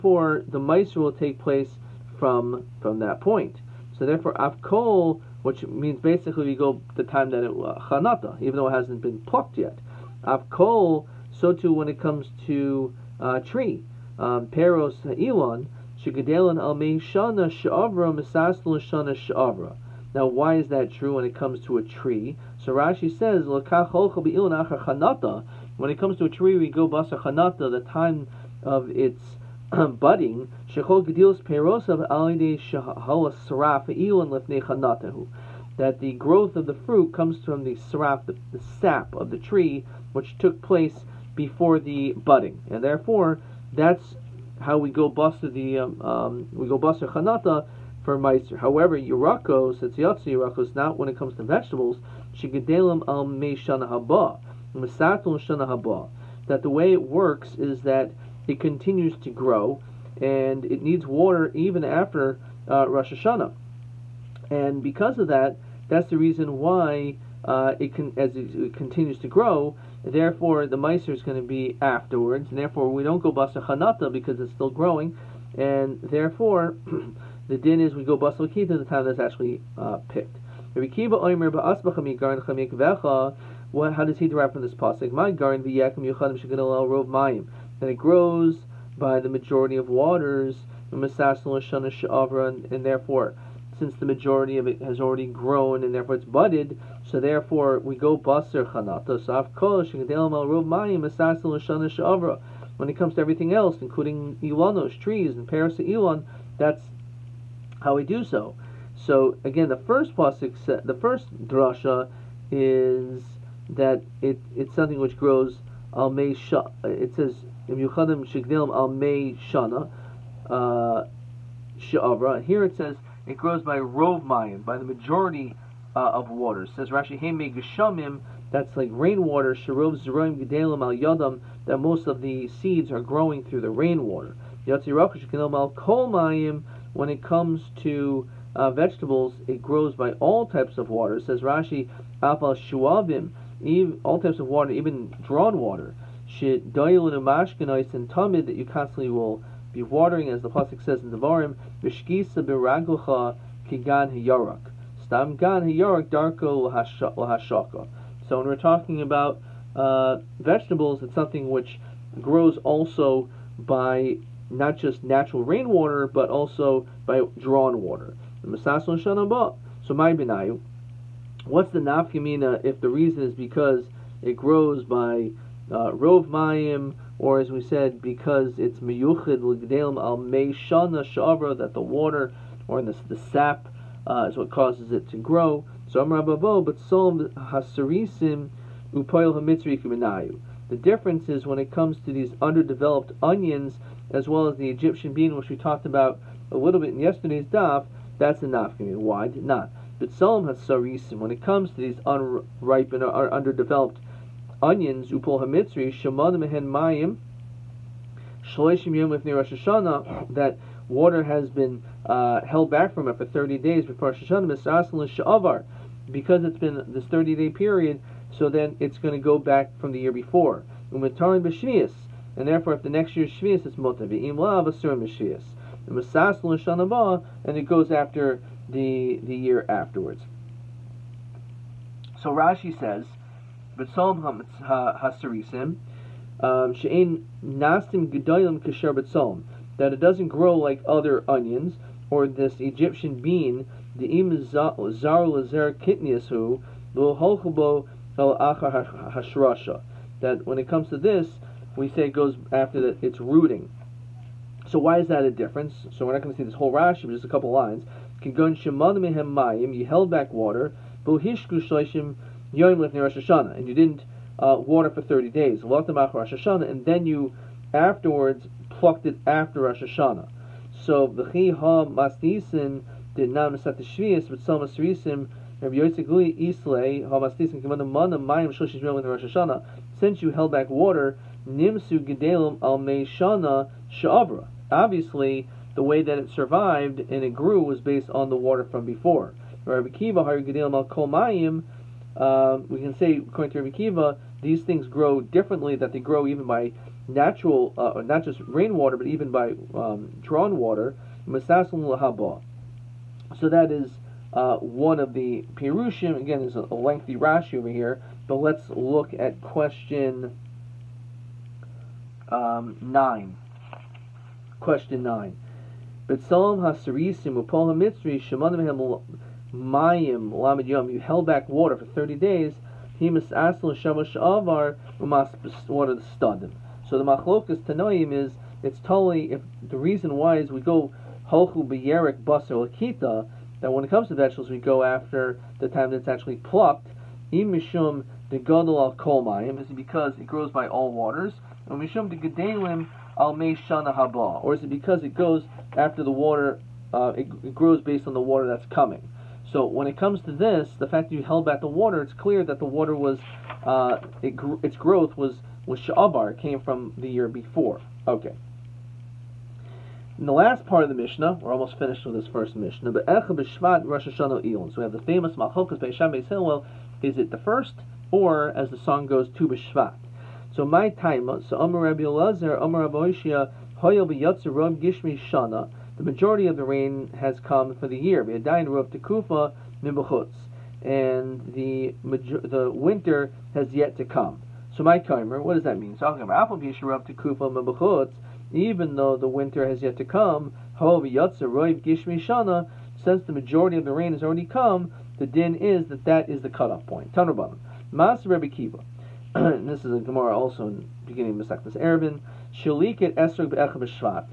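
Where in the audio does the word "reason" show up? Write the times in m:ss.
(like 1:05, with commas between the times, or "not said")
1:06, 2:52, 5:29.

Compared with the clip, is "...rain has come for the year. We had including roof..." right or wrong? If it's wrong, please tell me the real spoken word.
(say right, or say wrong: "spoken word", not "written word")
wrong: "dying", not "including".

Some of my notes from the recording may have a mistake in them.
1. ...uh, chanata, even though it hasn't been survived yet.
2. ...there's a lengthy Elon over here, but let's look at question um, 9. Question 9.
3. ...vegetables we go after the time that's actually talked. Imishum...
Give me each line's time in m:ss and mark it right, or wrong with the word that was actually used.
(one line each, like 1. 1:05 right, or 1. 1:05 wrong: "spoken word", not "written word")
1. 0:07 wrong: "plucked", not "survived"
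2. 5:06 wrong: "Rashi", not "Elon"
3. 5:34 wrong: "plucked", not "talked".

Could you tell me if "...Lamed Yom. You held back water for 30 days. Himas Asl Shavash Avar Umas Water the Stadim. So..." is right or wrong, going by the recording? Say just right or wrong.
right.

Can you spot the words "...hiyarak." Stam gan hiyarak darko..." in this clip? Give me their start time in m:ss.
2:34.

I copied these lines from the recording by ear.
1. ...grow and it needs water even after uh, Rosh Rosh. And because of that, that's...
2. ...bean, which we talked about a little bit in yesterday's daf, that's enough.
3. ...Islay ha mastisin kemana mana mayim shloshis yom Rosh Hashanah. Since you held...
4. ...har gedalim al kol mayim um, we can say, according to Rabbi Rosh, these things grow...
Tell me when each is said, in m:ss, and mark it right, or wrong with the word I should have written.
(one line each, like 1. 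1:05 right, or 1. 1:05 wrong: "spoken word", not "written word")
1. 0:59 wrong: "Hashanah", not "Rosh"
2. 3:15 right
3. 4:36 right
4. 4:50 wrong: "Kiva", not "Rosh".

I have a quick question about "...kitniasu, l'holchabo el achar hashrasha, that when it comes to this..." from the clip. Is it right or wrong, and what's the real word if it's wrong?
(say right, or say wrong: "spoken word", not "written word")
right.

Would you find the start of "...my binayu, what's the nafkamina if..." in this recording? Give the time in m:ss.
2:49.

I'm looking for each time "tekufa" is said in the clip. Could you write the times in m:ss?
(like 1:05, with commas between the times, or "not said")
6:18, 6:26.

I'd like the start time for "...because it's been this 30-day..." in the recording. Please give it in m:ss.
3:36.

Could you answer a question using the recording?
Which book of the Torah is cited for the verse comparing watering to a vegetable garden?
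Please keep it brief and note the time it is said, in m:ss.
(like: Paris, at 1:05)
Devarim, at 2:31.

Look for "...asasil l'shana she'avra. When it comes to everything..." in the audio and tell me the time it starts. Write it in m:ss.
1:41.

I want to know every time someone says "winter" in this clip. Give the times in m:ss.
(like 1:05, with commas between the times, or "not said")
6:22, 6:29.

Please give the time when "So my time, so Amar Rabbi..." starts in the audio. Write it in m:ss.
6:10.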